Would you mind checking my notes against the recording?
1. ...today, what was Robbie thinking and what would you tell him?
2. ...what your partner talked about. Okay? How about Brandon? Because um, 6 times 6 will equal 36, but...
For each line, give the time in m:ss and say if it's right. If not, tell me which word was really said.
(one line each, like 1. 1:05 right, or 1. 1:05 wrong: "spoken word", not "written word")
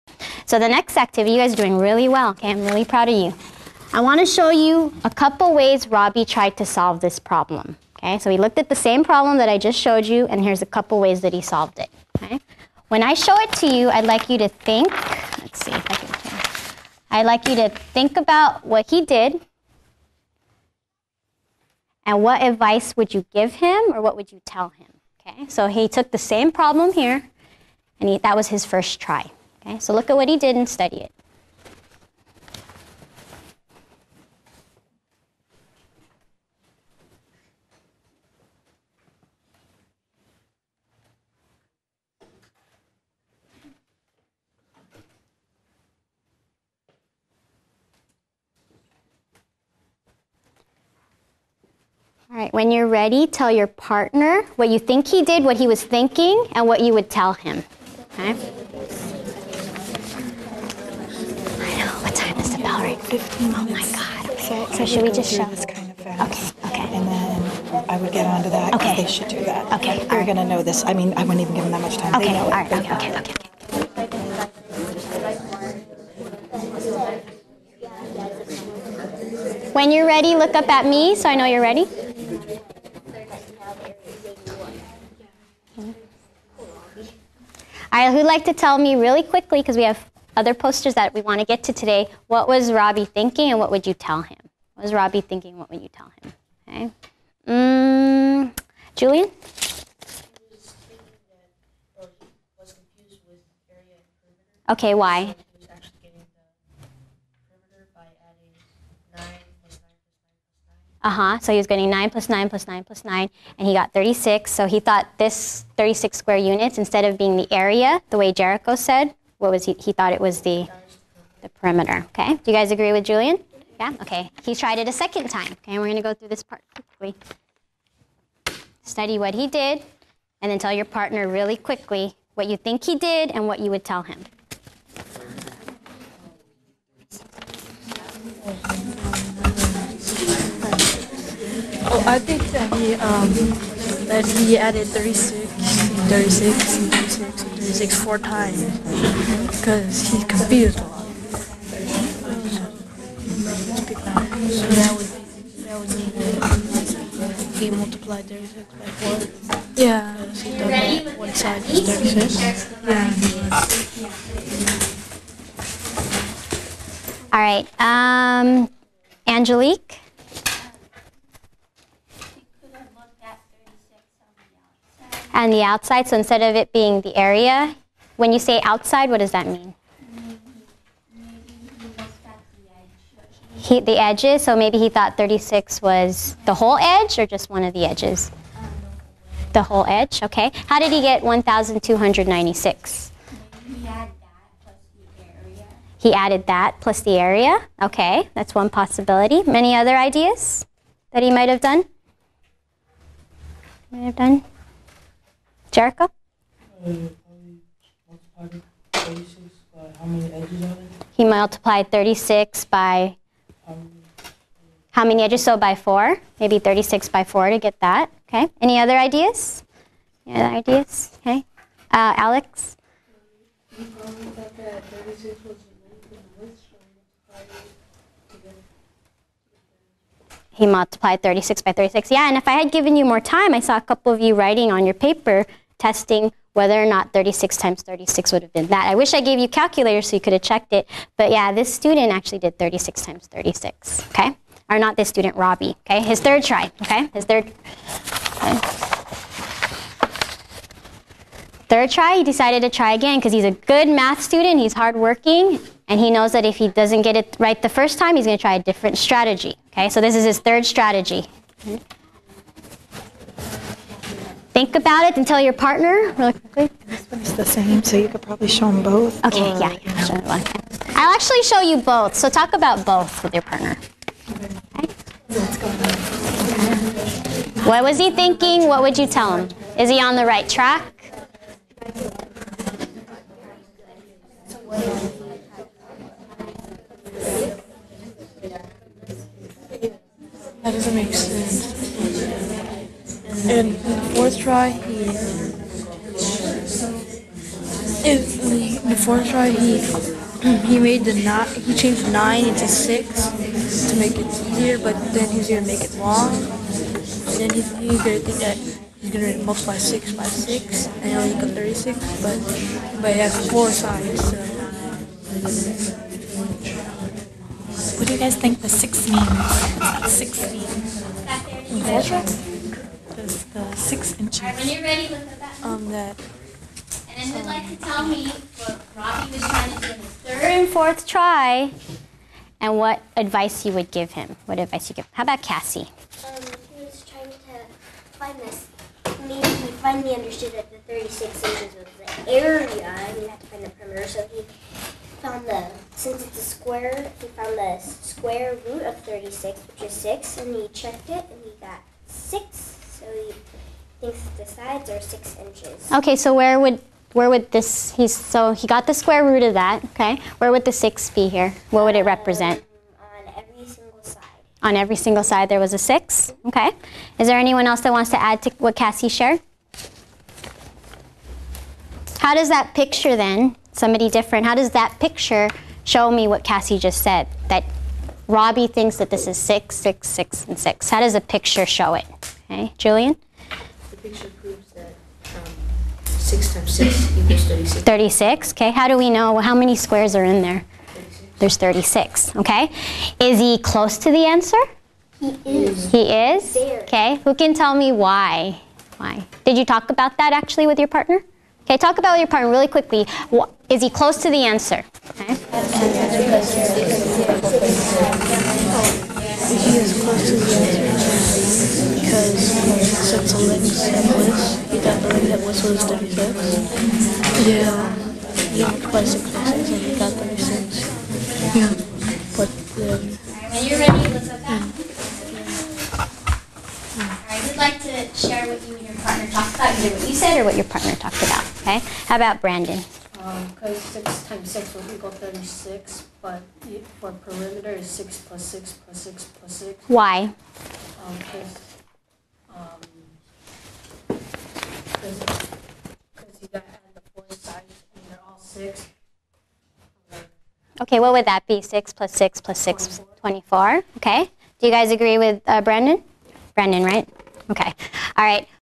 1. 1:31 right
2. 7:10 right.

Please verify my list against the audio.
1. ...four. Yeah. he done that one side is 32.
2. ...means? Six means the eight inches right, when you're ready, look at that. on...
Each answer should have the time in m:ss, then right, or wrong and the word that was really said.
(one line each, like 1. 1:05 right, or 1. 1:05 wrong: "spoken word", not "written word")
1. 2:38 wrong: "36", not "32"
2. 5:19 wrong: "six", not "eight".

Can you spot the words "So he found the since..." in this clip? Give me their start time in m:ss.
5:44.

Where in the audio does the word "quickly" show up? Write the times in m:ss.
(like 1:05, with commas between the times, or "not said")
1:29, 2:06, 2:11, 4:26, 6:42.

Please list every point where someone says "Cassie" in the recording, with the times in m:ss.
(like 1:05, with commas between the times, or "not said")
5:35, 6:08, 6:16.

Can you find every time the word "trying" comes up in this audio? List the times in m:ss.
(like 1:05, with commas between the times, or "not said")
5:29, 5:37.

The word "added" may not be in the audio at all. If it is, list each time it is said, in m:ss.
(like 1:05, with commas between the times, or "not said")
2:24, 3:16.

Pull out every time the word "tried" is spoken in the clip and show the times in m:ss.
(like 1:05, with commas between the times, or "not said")
0:06, 2:04.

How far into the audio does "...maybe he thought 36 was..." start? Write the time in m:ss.
3:04.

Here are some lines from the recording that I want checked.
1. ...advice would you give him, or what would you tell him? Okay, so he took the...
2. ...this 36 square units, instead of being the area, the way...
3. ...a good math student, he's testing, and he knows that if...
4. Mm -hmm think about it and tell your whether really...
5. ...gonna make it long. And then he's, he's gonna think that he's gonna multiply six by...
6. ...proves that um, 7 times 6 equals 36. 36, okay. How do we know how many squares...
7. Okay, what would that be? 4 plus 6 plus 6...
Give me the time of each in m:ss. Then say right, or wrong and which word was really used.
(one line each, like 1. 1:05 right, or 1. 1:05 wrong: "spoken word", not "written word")
1. 0:22 right
2. 1:55 right
3. 4:13 wrong: "hardworking", not "testing"
4. 4:21 wrong: "partner", not "whether"
5. 5:05 right
6. 6:24 wrong: "6", not "7"
7. 7:30 wrong: "6", not "4".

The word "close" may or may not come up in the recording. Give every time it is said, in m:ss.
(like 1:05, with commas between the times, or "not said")
6:33, 6:43.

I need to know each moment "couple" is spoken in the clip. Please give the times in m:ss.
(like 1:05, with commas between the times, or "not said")
0:05, 0:10, 3:53.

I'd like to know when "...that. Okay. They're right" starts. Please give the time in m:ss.
1:09.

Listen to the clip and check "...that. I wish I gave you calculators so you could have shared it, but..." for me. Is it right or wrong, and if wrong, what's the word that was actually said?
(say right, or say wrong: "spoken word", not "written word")
wrong: "checked", not "shared".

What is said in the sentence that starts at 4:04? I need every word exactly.
Or not this student, Robbie, okay?